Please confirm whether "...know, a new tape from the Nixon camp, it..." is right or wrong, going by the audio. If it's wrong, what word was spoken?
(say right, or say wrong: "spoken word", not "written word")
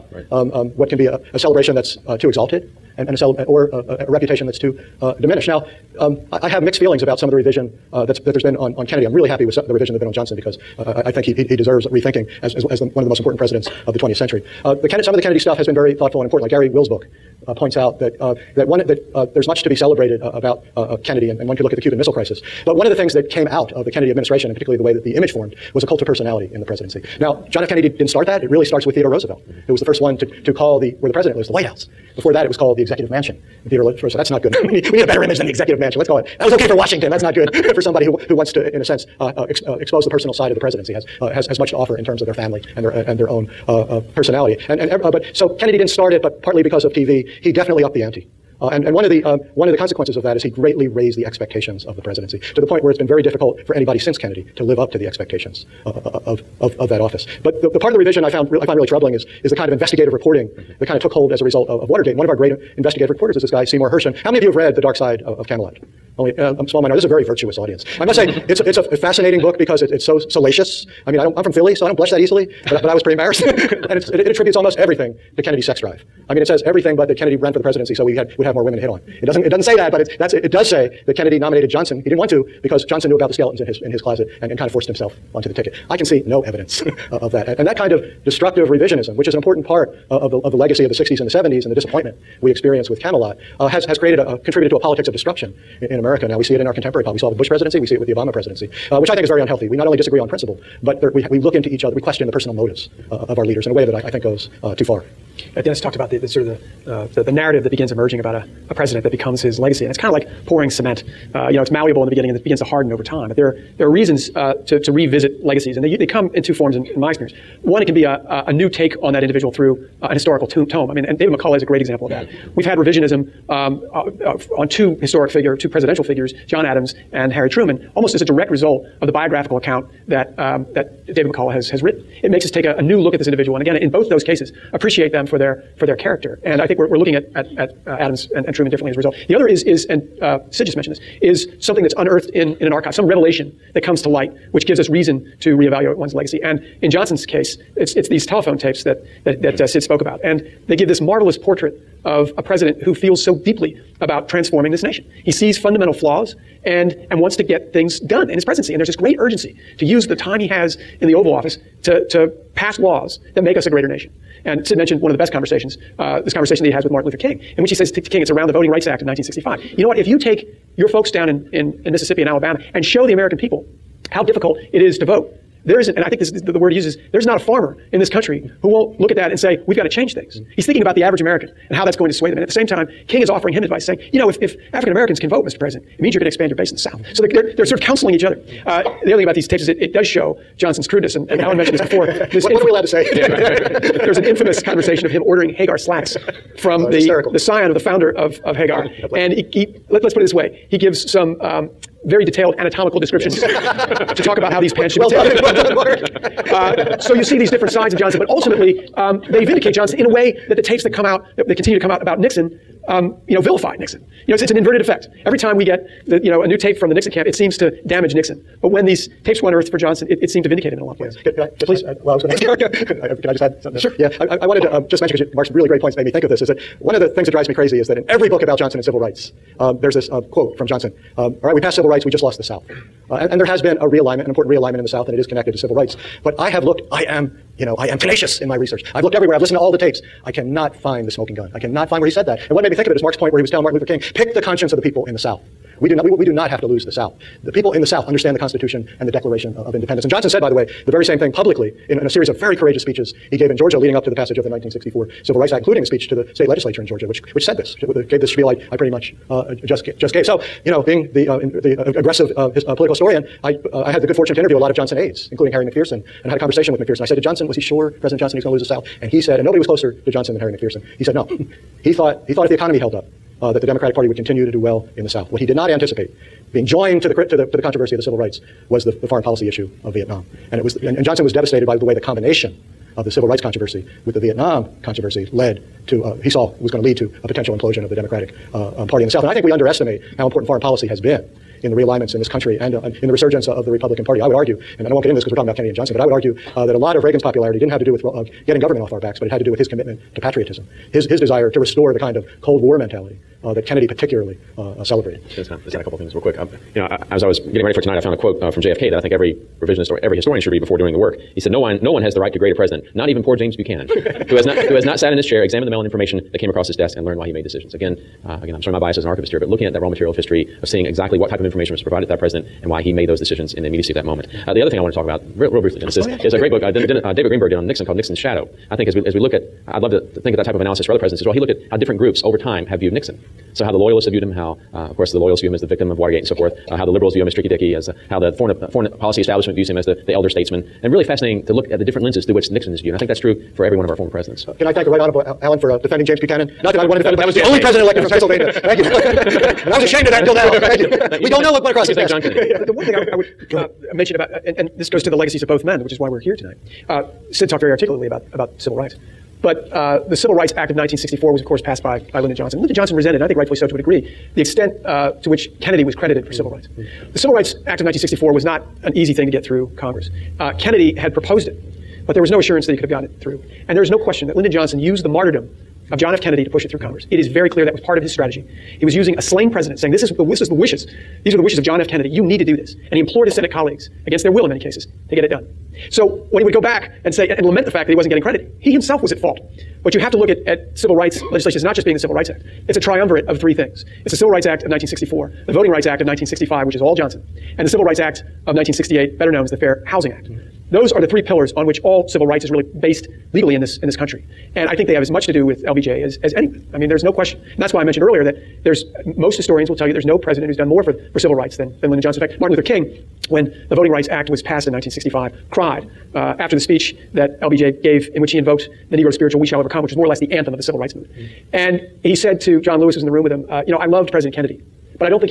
right.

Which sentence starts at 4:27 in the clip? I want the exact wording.
I said to Johnson, was he sure President Johnson he was going to lose the South?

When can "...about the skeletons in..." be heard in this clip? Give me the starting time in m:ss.
1:23.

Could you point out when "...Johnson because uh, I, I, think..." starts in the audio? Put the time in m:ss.
0:10.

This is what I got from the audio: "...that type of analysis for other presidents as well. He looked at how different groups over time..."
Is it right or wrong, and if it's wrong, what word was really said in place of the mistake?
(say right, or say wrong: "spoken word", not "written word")
right.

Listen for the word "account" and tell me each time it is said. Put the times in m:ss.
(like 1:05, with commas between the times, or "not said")
2:09.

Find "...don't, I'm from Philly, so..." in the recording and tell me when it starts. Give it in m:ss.
1:11.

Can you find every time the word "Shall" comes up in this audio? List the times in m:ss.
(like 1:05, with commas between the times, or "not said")
6:59.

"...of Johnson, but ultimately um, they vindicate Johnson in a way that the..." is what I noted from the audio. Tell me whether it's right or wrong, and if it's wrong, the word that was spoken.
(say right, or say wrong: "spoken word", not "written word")
right.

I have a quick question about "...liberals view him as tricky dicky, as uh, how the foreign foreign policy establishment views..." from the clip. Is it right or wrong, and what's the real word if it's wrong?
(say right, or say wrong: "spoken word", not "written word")
right.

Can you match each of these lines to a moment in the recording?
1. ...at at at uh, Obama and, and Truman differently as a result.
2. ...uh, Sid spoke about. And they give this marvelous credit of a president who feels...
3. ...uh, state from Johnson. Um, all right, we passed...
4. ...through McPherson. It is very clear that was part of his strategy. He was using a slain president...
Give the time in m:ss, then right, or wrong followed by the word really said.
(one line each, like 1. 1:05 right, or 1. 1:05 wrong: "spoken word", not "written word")
1. 2:17 wrong: "Adams", not "Obama"
2. 2:29 wrong: "portrait", not "credit"
3. 3:50 wrong: "quote", not "state"
4. 6:16 wrong: "Congress", not "McPherson".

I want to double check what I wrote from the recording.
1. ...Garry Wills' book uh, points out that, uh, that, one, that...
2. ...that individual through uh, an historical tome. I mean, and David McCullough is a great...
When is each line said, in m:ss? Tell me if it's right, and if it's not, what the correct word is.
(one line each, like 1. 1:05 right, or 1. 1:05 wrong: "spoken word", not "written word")
1. 0:16 right
2. 1:59 right.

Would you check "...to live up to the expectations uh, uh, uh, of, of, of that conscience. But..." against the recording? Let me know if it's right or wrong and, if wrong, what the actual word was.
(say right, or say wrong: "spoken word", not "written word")
wrong: "office", not "conscience".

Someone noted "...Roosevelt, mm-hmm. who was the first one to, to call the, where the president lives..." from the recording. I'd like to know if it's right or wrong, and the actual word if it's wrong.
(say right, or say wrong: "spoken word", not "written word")
right.